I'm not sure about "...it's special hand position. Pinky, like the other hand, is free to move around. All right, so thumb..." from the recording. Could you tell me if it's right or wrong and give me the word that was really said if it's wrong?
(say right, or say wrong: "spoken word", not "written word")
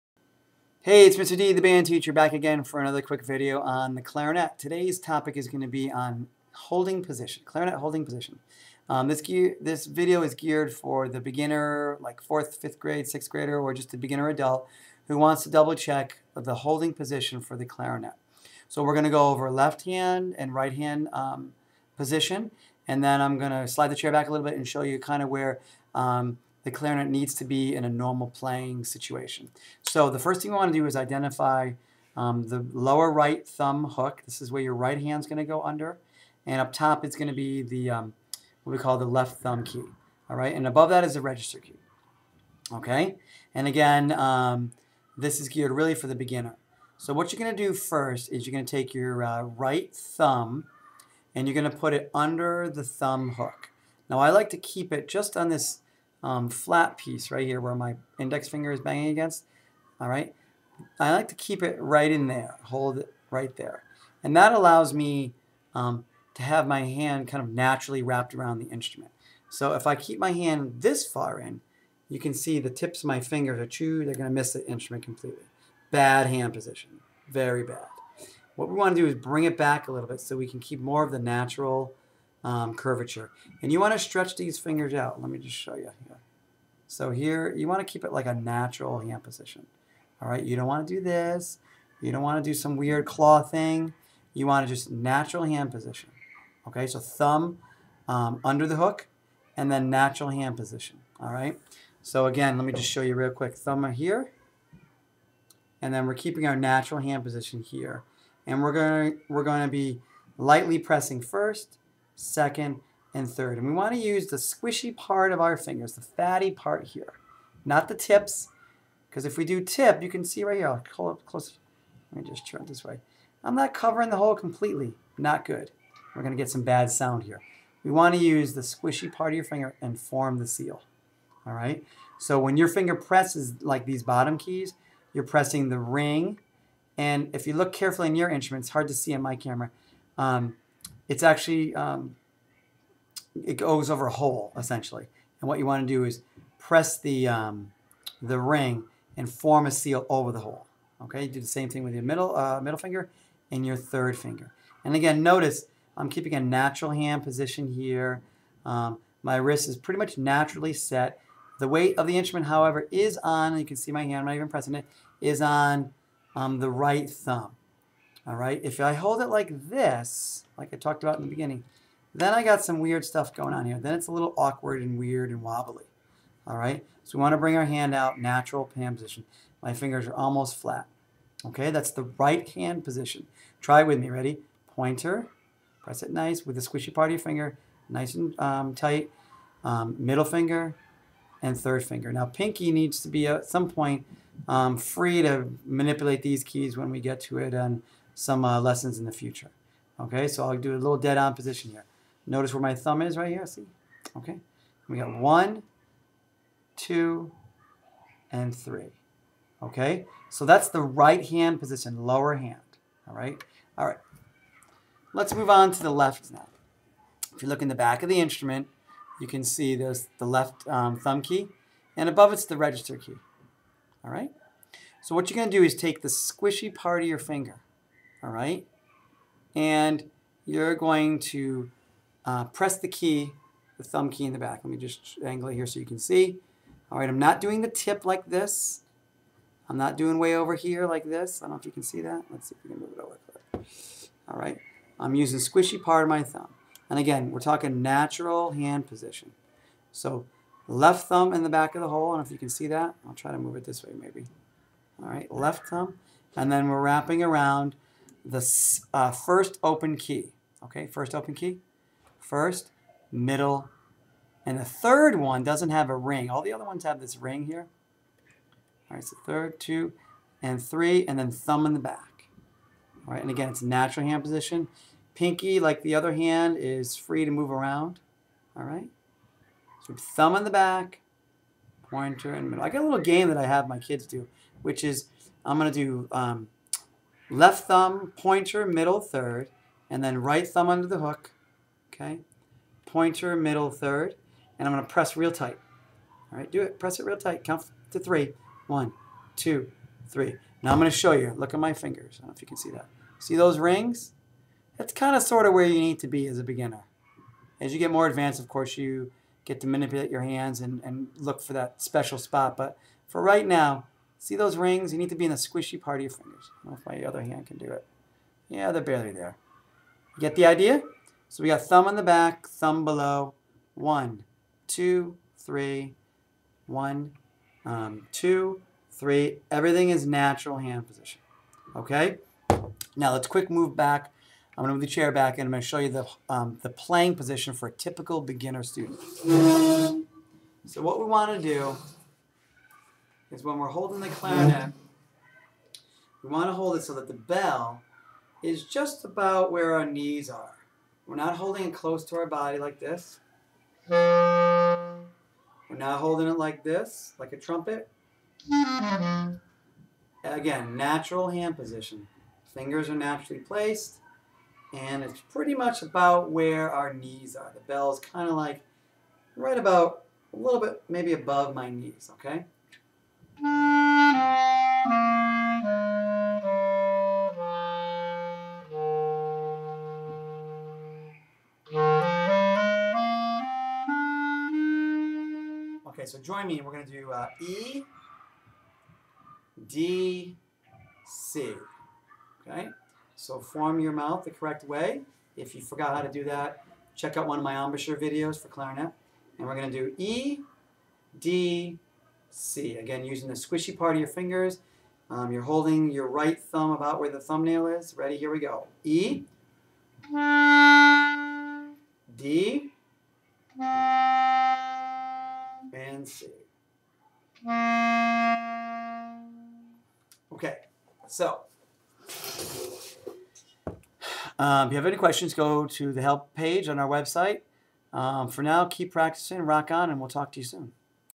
wrong: "natural", not "special".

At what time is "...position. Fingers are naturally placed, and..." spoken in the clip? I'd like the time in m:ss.
6:01.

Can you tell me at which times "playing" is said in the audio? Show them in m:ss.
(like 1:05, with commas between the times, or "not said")
0:28, 5:36.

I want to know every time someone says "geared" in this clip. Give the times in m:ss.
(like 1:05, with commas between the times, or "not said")
0:10, 0:45.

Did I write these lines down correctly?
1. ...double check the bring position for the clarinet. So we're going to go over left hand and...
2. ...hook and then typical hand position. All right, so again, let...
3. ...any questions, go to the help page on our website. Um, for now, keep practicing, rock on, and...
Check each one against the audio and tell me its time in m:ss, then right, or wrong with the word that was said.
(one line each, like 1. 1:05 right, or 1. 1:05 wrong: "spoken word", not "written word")
1. 0:15 wrong: "holding", not "bring"
2. 1:38 wrong: "natural", not "typical"
3. 7:04 right.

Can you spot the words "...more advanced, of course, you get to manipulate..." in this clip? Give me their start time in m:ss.
5:07.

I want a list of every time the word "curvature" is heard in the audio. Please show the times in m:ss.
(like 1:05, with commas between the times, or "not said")
1:22.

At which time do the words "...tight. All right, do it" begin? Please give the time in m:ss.
4:55.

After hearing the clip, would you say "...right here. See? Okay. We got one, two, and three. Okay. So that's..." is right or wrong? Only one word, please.
right.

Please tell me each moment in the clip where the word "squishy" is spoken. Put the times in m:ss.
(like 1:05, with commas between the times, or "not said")
1:54, 2:08, 3:06, 3:46, 4:05, 5:15, 6:43.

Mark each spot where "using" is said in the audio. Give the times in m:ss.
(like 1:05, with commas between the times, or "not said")
4:05, 6:43.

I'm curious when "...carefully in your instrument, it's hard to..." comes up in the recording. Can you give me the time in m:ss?
2:17.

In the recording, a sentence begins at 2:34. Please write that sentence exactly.
And again, notice I'm keeping a natural hand position here.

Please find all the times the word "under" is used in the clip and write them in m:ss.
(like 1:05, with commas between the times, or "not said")
0:35, 0:52, 1:38, 4:50.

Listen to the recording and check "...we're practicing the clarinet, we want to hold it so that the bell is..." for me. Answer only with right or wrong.
wrong.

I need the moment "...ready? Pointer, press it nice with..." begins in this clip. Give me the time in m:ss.
3:04.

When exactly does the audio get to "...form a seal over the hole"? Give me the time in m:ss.
2:29.